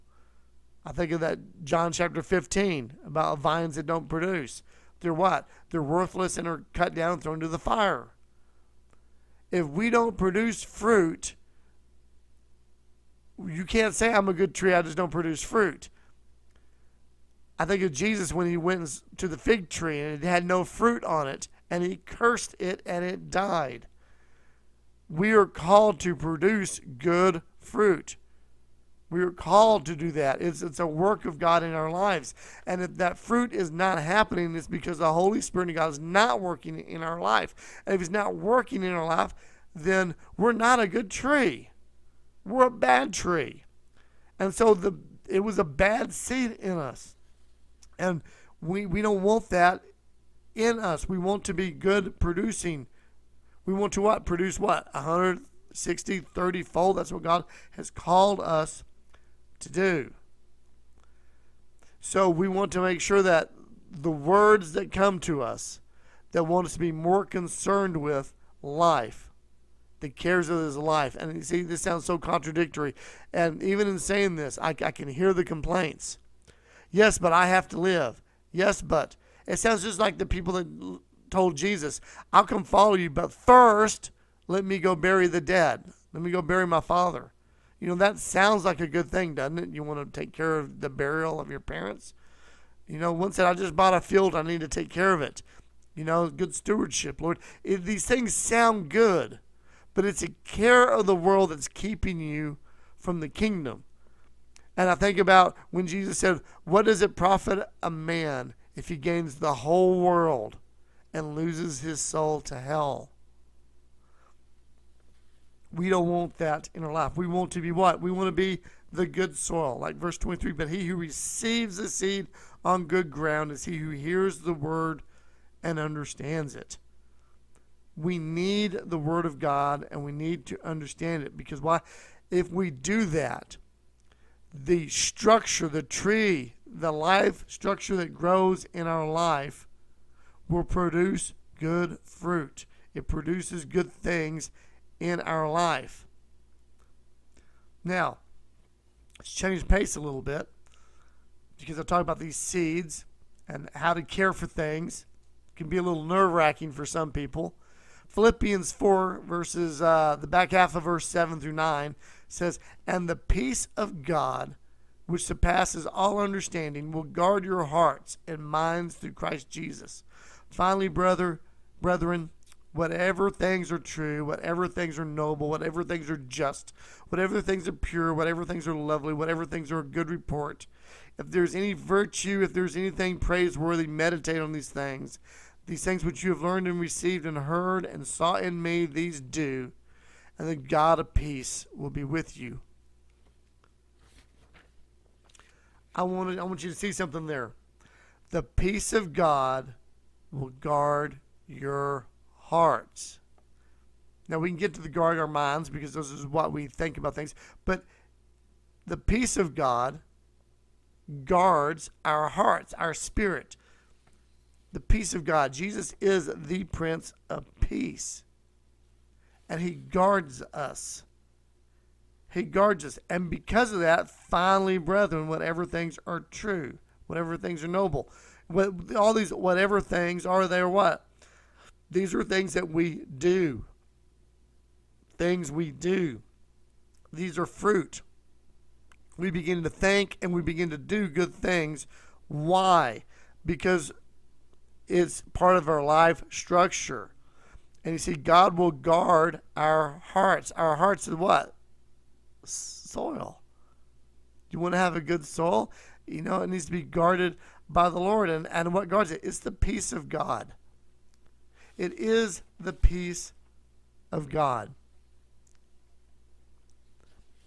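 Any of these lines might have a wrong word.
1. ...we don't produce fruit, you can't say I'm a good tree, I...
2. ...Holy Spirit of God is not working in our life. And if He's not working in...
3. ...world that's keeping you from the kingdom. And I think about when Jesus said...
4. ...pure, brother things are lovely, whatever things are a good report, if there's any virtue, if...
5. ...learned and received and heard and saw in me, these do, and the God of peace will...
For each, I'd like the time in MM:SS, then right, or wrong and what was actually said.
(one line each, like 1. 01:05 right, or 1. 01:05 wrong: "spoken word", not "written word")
1. 00:09 right
2. 00:35 right
3. 01:41 right
4. 02:57 wrong: "whatever", not "brother"
5. 03:06 right.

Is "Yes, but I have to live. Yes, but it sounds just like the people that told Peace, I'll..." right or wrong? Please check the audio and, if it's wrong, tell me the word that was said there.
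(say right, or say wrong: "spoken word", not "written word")
wrong: "Jesus", not "Peace".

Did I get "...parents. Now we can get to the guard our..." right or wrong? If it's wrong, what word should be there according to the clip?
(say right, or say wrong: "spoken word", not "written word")
wrong: "hearts", not "parents".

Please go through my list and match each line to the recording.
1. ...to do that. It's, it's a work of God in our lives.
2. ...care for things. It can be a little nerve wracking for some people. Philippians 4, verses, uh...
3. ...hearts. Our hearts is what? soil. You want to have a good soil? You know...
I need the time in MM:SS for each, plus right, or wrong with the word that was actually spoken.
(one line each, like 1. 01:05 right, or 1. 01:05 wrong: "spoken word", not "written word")
1. 00:29 right
2. 02:34 right
3. 04:10 right.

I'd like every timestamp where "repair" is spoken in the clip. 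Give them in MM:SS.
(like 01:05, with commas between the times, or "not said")
not said.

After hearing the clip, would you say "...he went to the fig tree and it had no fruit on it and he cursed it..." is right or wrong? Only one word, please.
right.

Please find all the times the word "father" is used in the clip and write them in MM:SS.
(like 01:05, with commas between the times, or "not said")
01:26.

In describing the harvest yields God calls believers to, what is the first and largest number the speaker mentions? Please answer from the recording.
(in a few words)
160.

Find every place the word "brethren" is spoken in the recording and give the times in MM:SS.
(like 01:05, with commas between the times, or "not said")
02:51, 03:44.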